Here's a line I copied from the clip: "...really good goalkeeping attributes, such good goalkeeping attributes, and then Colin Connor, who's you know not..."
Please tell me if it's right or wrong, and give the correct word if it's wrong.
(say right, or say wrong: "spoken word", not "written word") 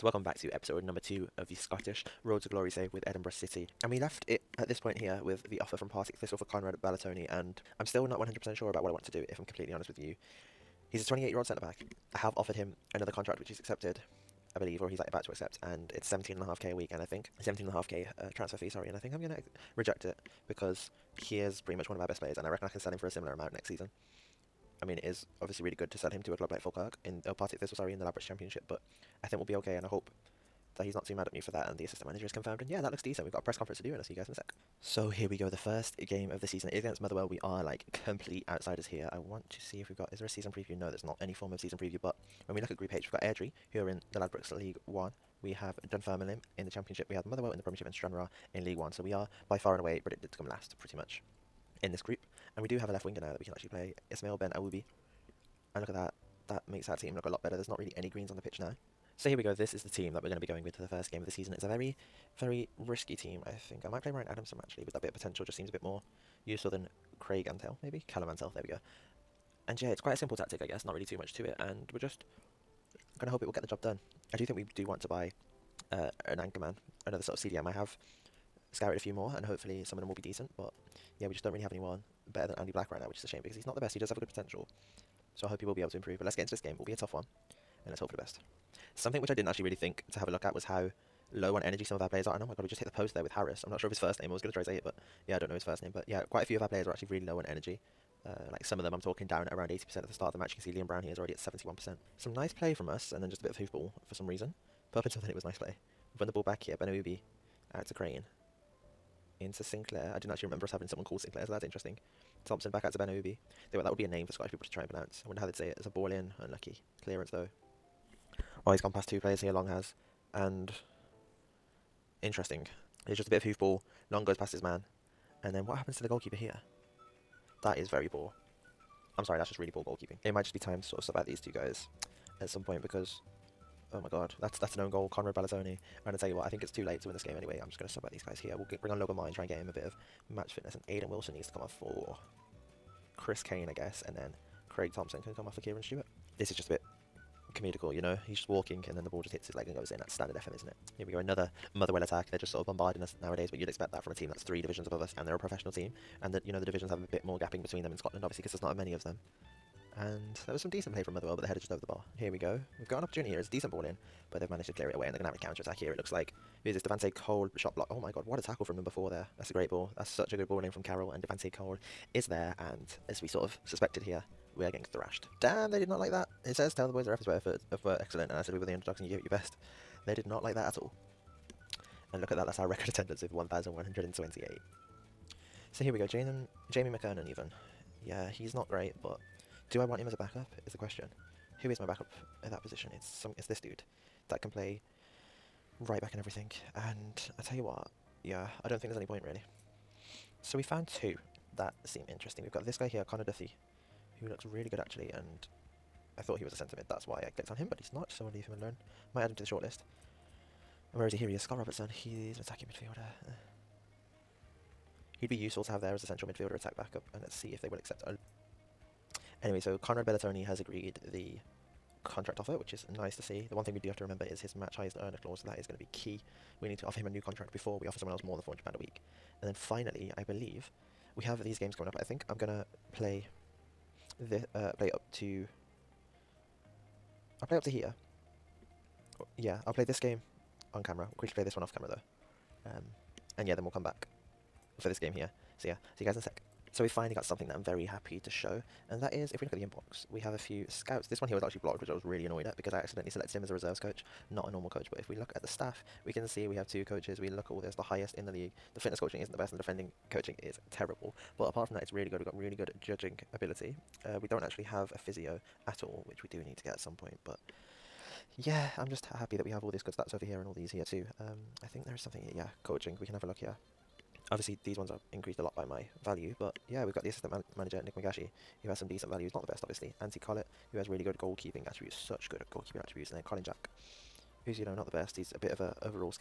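wrong: "Jack", not "Connor".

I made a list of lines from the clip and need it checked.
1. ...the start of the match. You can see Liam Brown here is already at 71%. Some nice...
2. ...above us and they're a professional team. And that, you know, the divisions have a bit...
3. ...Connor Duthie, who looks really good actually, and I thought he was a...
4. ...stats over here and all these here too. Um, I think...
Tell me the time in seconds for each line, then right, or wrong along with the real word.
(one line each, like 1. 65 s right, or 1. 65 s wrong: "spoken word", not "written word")
1. 100 s right
2. 154 s right
3. 203 s right
4. 269 s right.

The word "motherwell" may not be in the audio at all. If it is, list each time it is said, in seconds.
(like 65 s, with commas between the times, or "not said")
36 s, 47 s, 151 s, 161 s.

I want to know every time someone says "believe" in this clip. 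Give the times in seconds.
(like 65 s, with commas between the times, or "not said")
14 s, 230 s.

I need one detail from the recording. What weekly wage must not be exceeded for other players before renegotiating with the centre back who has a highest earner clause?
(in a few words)
£400 a week.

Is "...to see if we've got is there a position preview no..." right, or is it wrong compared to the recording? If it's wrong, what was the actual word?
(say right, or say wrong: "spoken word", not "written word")
wrong: "season", not "position".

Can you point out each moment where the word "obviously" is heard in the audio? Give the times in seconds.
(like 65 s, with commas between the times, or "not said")
25 s, 158 s, 274 s, 279 s.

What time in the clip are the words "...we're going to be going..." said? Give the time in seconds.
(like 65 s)
60 s.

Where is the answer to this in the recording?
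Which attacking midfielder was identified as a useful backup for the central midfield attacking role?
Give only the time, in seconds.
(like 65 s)
211 s.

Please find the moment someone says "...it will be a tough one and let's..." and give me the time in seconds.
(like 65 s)
86 s.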